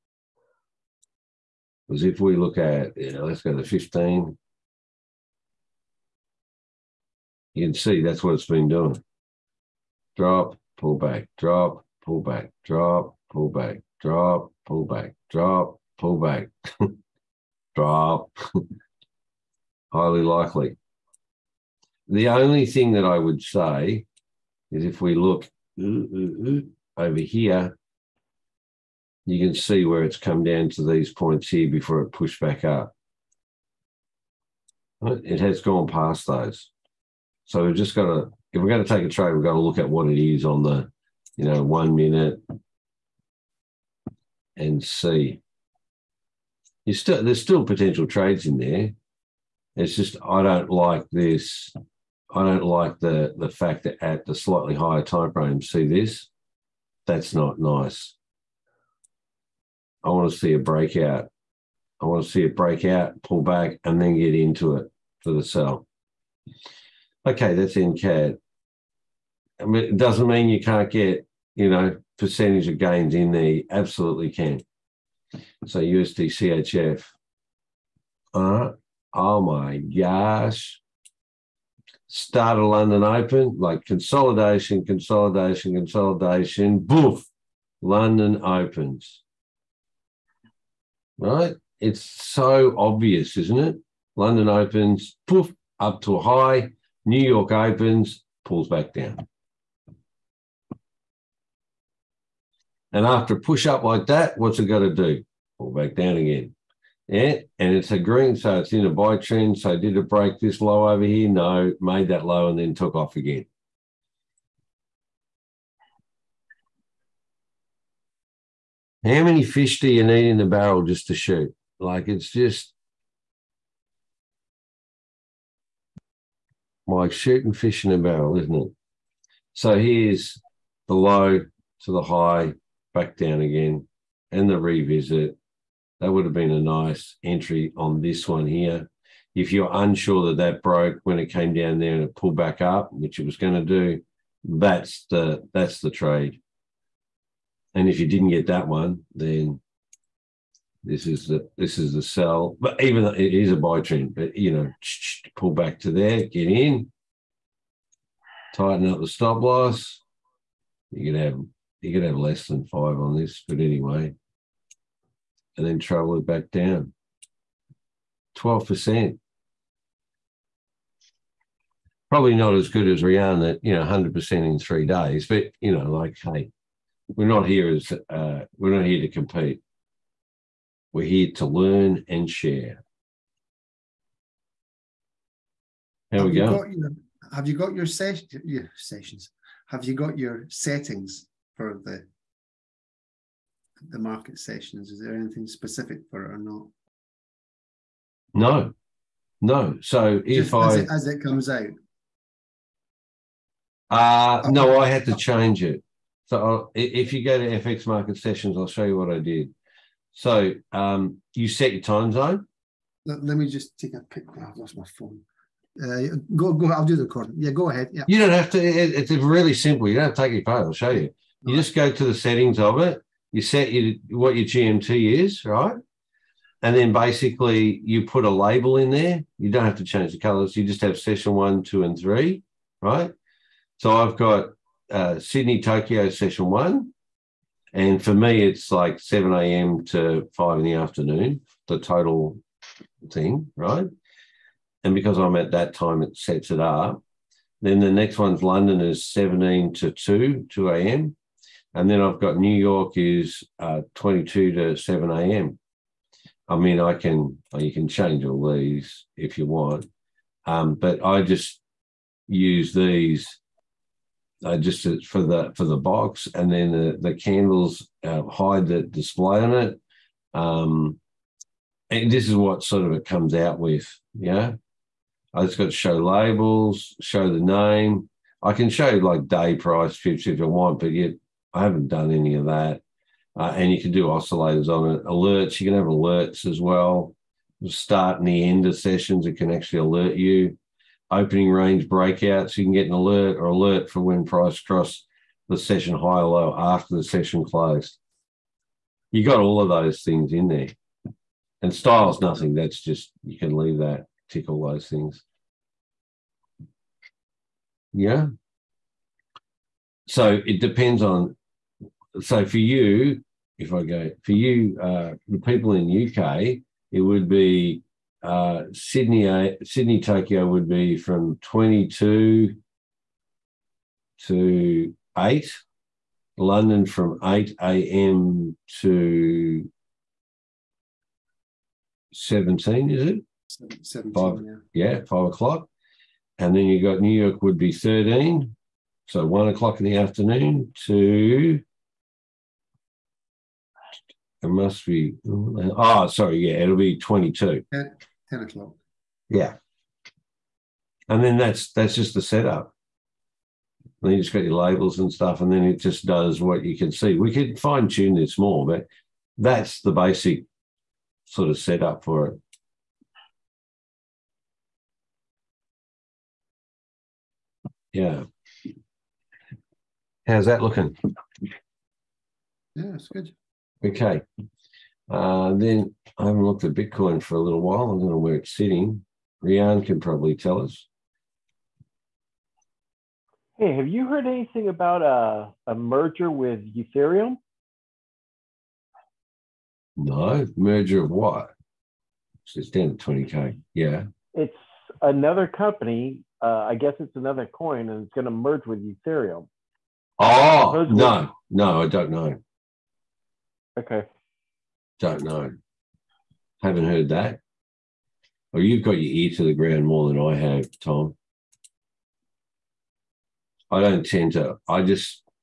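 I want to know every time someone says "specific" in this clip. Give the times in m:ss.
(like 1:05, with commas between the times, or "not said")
3:15.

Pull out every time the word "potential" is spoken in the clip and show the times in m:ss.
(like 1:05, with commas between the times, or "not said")
0:47.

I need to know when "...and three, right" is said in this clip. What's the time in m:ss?
3:51.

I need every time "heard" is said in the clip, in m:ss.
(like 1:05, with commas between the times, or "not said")
6:24, 6:46.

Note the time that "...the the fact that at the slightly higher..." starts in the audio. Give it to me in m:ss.
0:52.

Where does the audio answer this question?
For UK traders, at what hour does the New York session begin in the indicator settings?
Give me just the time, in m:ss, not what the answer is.
5:37.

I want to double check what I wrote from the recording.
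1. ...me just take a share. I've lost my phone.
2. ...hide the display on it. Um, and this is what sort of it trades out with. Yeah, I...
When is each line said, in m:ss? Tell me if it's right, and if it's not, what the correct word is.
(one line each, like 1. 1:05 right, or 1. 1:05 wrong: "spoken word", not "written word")
1. 3:33 wrong: "picture", not "share"
2. 4:28 wrong: "comes", not "trades".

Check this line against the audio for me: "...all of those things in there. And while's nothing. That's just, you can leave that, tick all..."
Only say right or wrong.
wrong.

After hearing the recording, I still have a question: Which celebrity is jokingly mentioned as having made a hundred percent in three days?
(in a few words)
Rihanna.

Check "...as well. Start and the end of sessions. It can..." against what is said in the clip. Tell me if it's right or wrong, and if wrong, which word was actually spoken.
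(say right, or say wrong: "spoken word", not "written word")
right.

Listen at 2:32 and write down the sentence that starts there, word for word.
But even though it is a buy trend, but you know, pull back to there, get in, tighten up the stop loss.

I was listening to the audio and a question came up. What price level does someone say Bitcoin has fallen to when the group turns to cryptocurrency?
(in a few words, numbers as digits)
20K.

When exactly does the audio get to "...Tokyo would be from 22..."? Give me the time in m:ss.
5:20.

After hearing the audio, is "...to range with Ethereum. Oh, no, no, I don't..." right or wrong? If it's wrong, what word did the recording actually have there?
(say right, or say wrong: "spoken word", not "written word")
wrong: "merge", not "range".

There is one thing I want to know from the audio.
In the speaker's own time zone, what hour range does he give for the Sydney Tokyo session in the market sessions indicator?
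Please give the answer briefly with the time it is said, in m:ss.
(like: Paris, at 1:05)
7 a.m. to 5 p.m., at 3:58.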